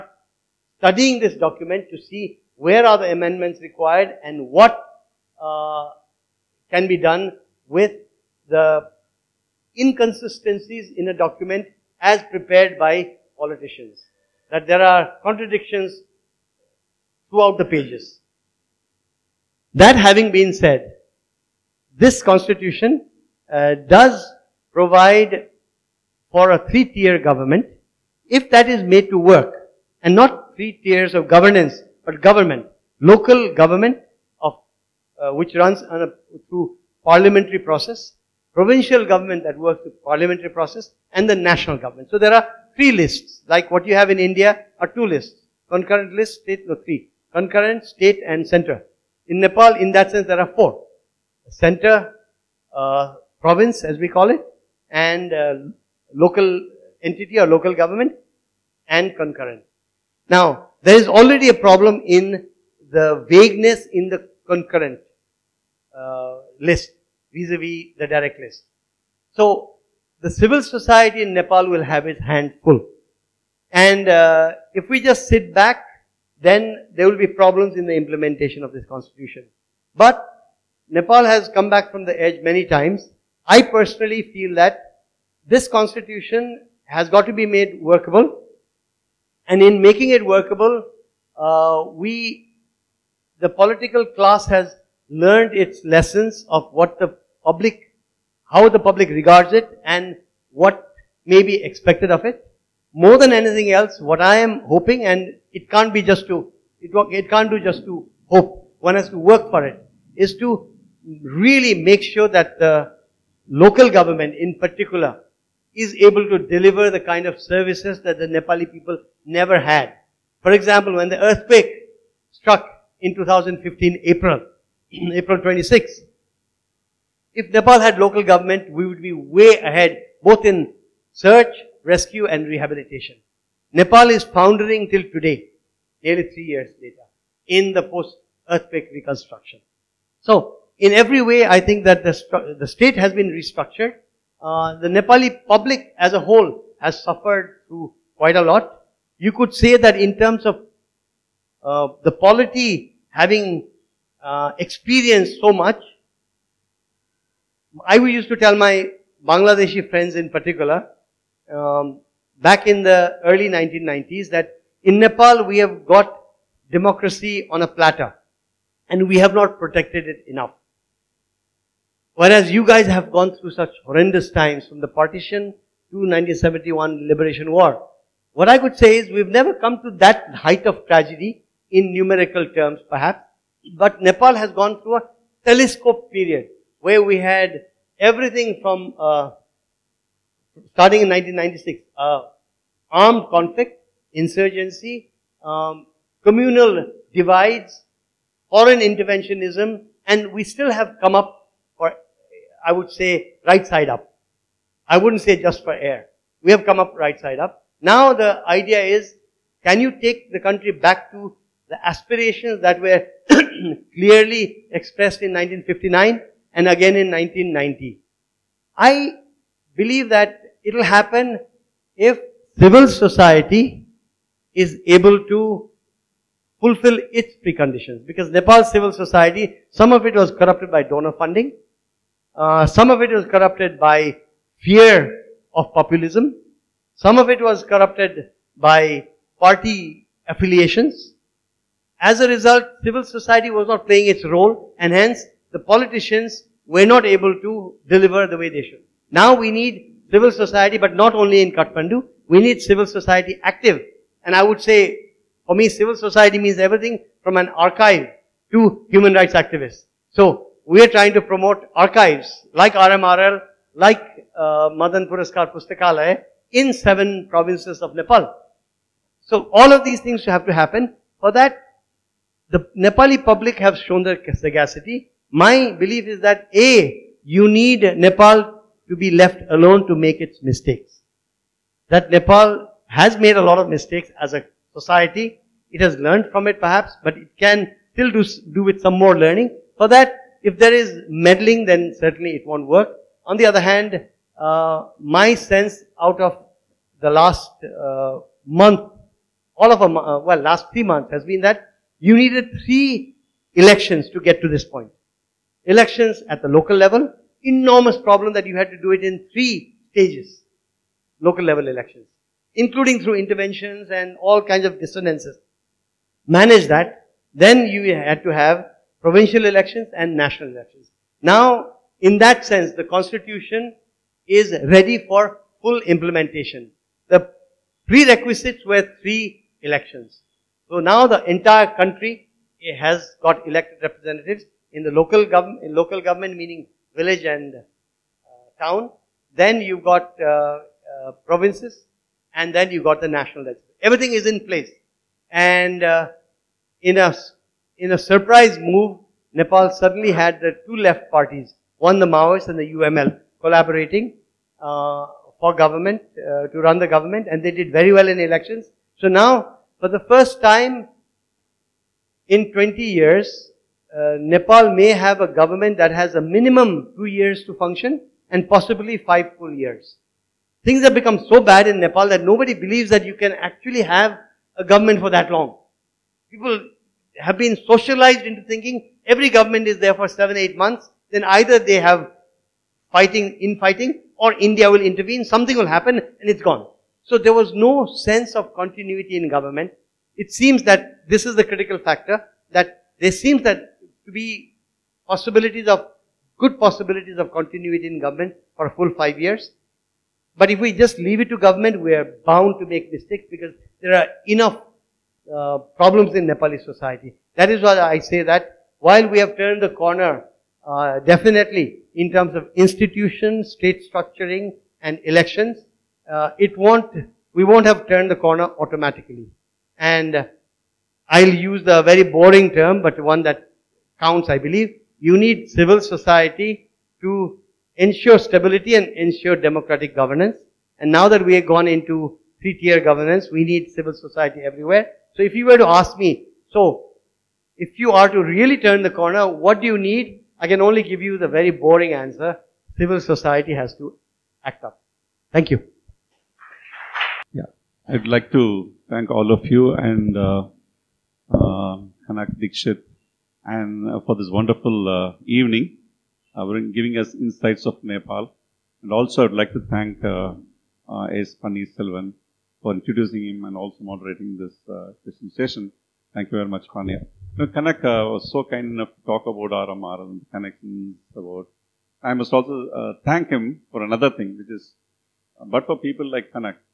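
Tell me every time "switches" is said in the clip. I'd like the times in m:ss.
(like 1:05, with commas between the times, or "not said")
not said.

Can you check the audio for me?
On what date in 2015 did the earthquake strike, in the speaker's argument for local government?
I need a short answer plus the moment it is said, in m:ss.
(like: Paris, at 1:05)
April 26, at 2:05.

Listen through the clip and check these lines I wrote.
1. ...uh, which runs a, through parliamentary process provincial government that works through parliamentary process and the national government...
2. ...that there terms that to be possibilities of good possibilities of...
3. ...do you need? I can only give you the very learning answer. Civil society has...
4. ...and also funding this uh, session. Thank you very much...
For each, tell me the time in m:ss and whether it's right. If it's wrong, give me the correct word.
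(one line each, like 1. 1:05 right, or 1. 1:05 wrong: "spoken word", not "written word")
1. 0:35 right
2. 6:32 wrong: "seems", not "terms"
3. 7:19 wrong: "boring", not "learning"
4. 7:43 wrong: "moderating", not "funding".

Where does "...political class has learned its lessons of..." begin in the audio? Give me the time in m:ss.
1:33.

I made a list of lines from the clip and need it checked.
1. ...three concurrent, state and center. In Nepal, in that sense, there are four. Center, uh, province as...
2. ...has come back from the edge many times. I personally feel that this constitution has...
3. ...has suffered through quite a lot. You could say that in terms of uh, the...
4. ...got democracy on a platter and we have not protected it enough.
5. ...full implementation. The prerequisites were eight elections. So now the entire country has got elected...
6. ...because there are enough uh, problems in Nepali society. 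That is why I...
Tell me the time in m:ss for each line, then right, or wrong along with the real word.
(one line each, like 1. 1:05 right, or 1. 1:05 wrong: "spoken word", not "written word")
1. 0:46 right
2. 1:21 right
3. 2:26 right
4. 2:45 right
5. 5:25 wrong: "three", not "eight"
6. 6:43 right.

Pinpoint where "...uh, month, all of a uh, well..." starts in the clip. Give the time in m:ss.
4:57.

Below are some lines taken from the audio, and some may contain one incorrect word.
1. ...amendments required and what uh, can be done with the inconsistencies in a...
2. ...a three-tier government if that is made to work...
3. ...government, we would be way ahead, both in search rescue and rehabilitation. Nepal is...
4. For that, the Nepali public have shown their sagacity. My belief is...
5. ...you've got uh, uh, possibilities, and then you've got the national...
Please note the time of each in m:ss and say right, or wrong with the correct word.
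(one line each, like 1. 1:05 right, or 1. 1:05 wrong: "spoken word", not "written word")
1. 0:03 right
2. 0:26 right
3. 2:08 right
4. 4:31 right
5. 5:39 wrong: "provinces", not "possibilities".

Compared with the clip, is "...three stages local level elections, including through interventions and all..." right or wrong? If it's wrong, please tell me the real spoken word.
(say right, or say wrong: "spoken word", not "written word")
right.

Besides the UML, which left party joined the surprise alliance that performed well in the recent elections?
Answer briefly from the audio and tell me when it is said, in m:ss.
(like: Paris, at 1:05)
The Maoists, at 5:51.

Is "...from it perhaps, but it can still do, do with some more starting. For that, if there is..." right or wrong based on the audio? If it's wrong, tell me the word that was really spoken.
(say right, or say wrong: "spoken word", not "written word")
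wrong: "learning", not "starting".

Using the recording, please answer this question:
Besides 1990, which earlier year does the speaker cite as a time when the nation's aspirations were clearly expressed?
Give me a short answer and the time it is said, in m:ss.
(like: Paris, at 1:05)
1959, at 3:35.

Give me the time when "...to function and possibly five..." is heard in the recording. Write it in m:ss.
6:07.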